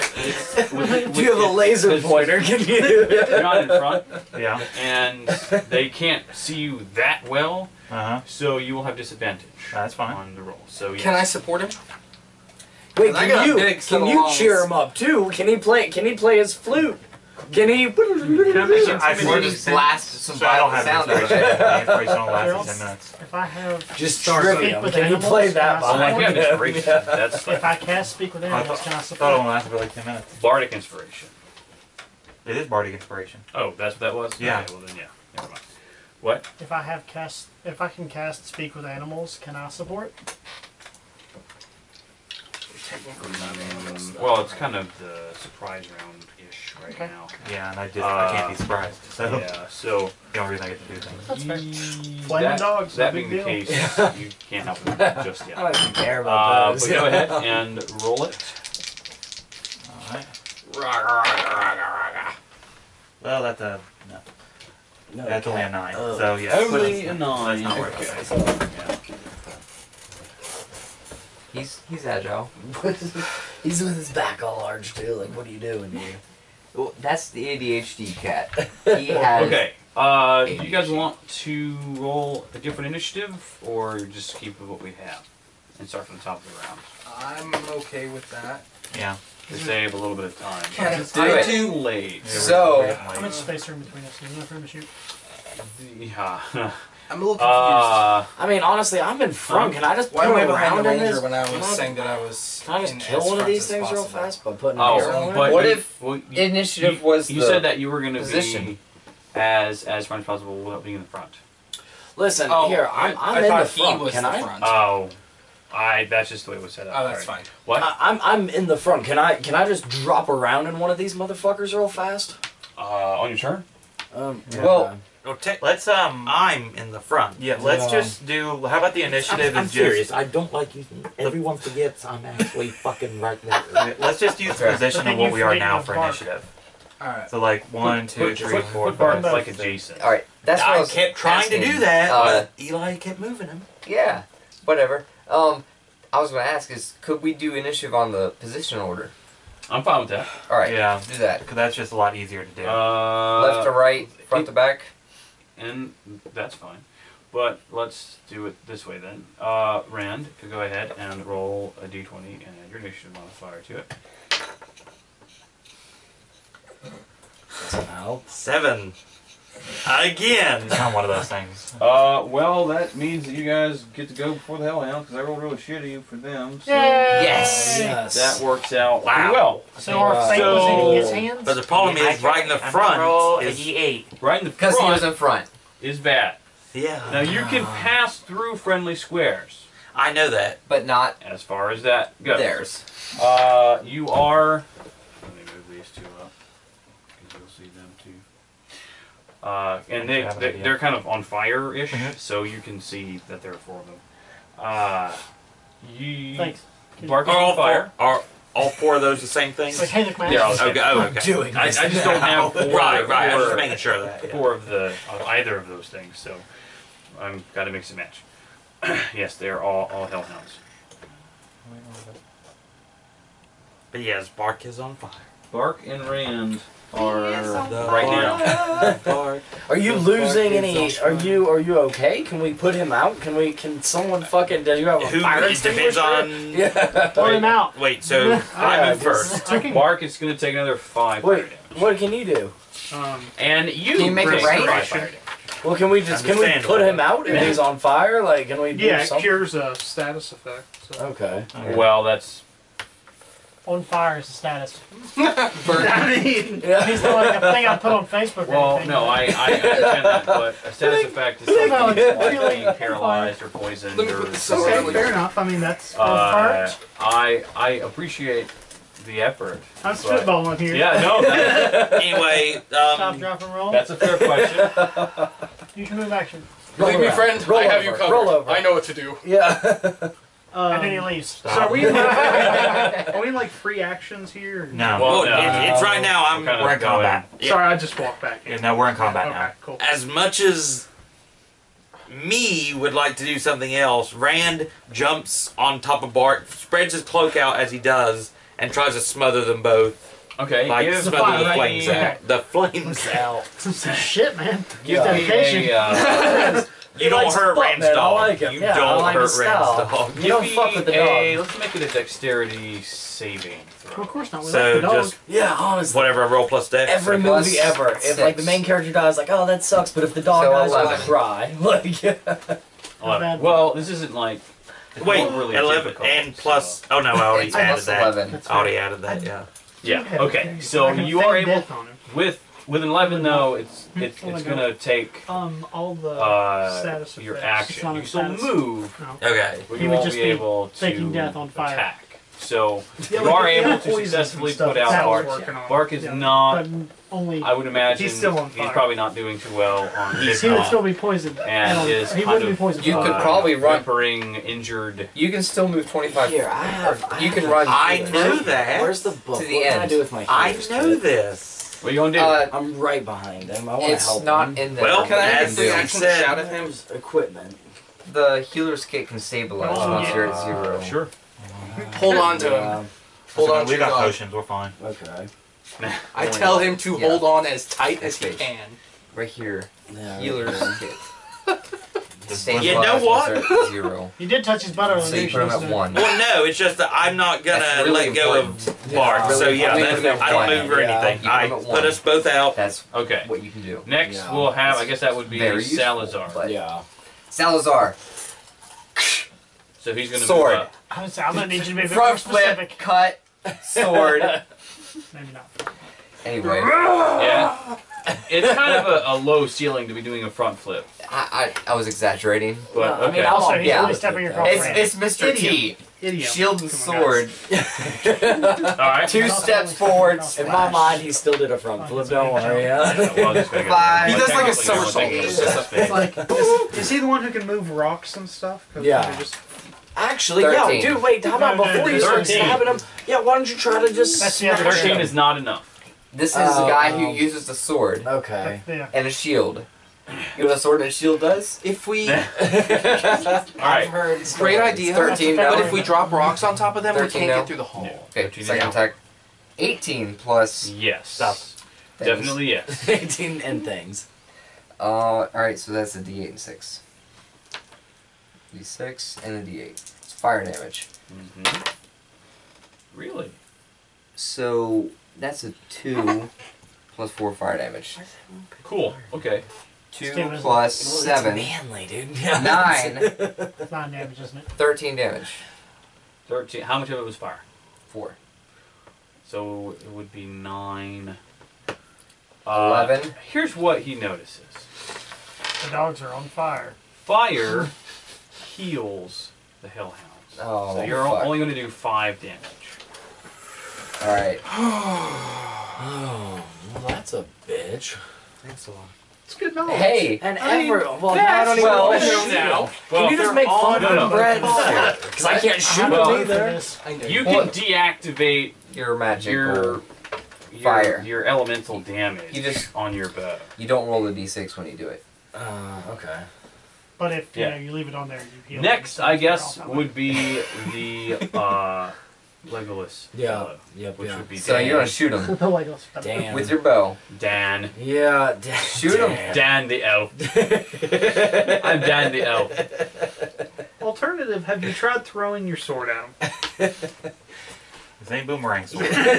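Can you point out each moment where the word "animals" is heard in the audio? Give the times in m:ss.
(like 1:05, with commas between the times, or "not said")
0:28, 0:38.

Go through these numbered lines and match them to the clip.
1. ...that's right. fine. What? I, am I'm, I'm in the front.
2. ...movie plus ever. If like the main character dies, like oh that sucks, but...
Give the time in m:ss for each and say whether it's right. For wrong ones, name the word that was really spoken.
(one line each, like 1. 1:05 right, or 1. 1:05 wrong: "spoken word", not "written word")
1. 1:57 right
2. 5:17 right.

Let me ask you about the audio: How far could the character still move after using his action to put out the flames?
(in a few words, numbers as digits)
25.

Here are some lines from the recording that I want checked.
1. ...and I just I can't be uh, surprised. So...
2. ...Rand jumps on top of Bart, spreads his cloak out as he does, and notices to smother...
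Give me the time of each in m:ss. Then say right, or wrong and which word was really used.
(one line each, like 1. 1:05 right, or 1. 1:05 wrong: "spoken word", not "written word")
1. 0:47 right
2. 4:54 wrong: "tries", not "notices".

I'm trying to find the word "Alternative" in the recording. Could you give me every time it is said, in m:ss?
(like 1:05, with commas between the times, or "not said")
8:53.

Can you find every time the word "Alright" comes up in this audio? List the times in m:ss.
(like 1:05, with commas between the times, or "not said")
7:35, 8:14.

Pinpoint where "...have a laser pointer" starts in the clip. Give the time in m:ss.
0:01.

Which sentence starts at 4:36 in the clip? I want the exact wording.
Believe me, friend, roll I have over.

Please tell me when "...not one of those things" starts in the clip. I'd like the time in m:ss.
2:50.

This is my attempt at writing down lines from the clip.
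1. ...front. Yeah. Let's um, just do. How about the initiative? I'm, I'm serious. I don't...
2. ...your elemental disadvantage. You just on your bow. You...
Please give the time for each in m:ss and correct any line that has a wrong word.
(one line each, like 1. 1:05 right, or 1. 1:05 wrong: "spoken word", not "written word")
1. 2:06 right
2. 8:31 wrong: "damage", not "disadvantage".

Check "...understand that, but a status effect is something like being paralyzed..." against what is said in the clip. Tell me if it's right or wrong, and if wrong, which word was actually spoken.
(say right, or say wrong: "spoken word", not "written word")
right.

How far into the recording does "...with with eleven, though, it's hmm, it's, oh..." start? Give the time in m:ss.
5:32.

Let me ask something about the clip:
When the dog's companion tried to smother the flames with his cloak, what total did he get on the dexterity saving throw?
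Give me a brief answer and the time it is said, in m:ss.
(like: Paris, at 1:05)
11, at 5:25.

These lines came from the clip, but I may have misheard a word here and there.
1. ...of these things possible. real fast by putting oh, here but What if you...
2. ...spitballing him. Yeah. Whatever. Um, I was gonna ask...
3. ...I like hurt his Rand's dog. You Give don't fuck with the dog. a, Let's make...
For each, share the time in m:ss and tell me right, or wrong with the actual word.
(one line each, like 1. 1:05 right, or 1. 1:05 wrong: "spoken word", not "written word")
1. 1:43 right
2. 2:23 wrong: "moving", not "spitballing"
3. 5:08 right.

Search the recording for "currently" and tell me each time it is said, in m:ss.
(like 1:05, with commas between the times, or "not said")
not said.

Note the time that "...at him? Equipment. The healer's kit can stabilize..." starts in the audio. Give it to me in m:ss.
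6:06.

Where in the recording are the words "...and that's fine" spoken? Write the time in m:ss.
2:35.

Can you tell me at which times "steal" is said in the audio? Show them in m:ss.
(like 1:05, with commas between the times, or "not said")
not said.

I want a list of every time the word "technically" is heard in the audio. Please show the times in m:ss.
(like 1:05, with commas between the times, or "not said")
0:42.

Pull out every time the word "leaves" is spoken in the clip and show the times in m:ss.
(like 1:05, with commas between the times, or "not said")
4:40, 8:37.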